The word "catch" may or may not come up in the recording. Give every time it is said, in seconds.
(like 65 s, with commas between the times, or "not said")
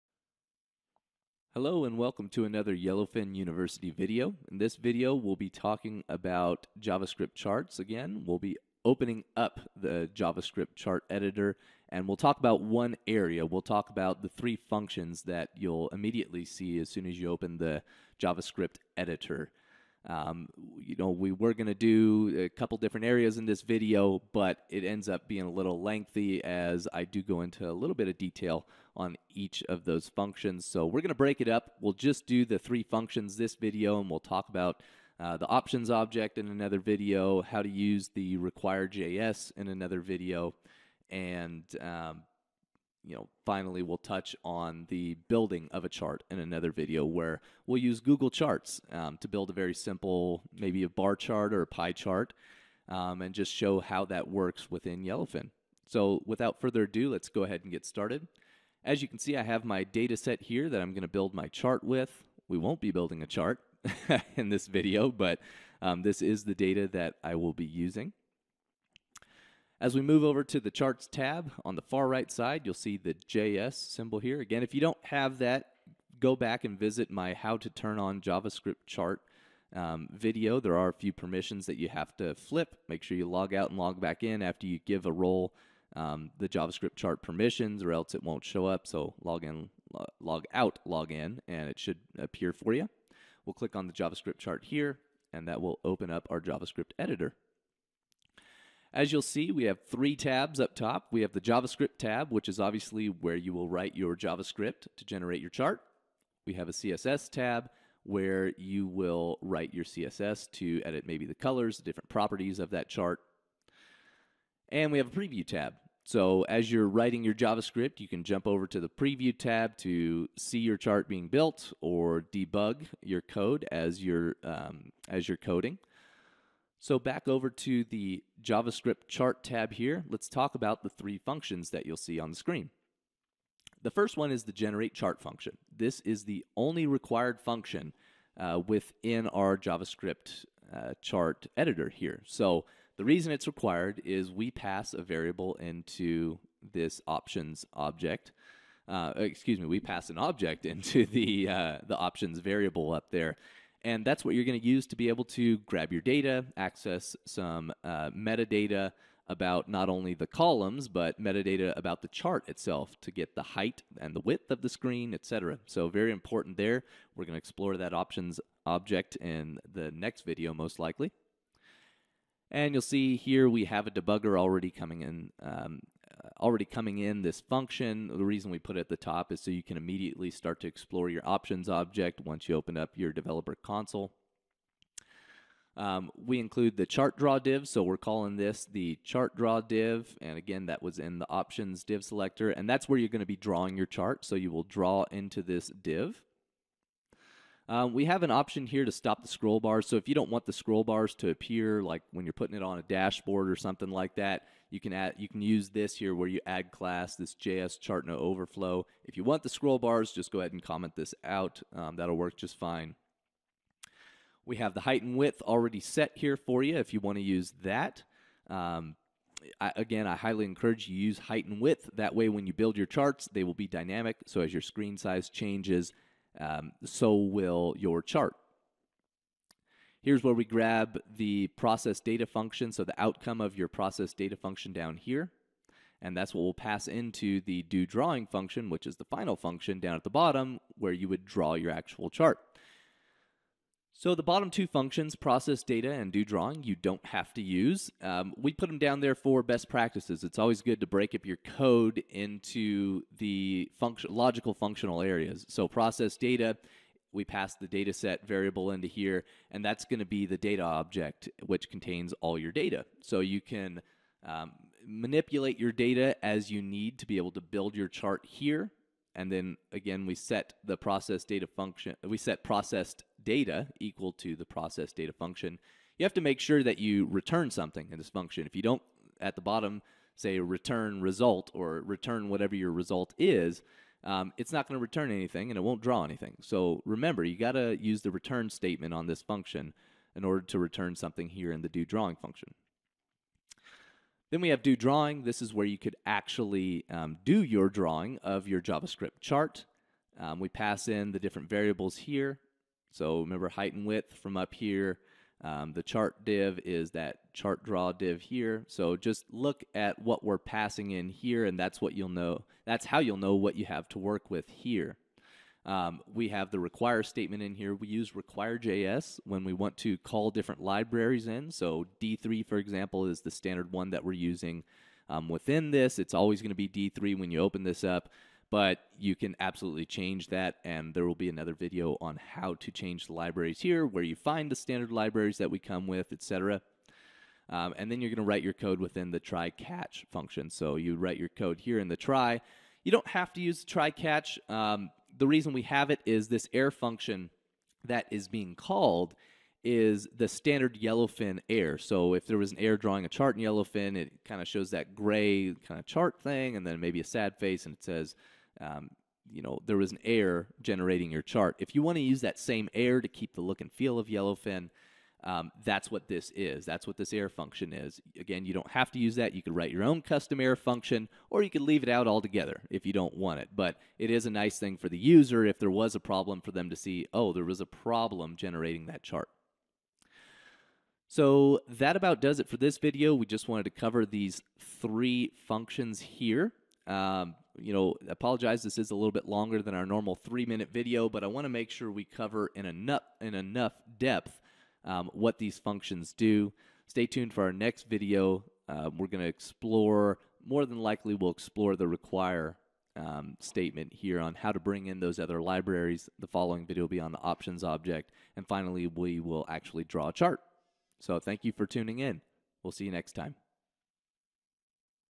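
339 s, 343 s.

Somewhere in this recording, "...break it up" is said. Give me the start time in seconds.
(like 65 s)
31 s.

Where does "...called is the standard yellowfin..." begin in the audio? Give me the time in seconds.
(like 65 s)
348 s.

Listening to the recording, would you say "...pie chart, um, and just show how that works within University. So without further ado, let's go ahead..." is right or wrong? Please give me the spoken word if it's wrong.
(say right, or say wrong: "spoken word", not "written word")
wrong: "Yellowfin", not "University".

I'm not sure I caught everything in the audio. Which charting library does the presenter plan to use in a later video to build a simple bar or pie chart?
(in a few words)
Google Charts.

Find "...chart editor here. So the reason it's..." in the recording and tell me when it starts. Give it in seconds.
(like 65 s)
141 s.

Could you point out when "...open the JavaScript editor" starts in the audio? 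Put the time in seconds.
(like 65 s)
17 s.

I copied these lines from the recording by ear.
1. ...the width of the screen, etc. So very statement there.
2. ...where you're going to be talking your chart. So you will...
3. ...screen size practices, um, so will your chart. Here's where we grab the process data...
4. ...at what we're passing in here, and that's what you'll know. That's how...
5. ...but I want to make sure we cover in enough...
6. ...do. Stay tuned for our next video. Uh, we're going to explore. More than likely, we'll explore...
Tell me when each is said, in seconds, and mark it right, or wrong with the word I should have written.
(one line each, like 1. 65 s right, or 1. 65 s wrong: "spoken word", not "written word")
1. 164 s wrong: "important", not "statement"
2. 192 s wrong: "drawing", not "talking"
3. 224 s wrong: "changes", not "practices"
4. 309 s right
5. 391 s right
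6. 396 s right.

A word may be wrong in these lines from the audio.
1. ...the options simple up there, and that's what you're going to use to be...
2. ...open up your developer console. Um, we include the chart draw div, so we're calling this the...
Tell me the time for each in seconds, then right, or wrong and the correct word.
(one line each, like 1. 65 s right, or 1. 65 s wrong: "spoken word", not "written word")
1. 151 s wrong: "variable", not "simple"
2. 182 s right.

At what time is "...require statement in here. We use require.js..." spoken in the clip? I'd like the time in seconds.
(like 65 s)
316 s.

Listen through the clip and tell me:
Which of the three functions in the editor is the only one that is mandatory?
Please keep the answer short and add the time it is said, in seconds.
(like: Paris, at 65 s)
generate chart, at 134 s.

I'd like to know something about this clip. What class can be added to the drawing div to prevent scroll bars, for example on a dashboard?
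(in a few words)
JS chart no overflow.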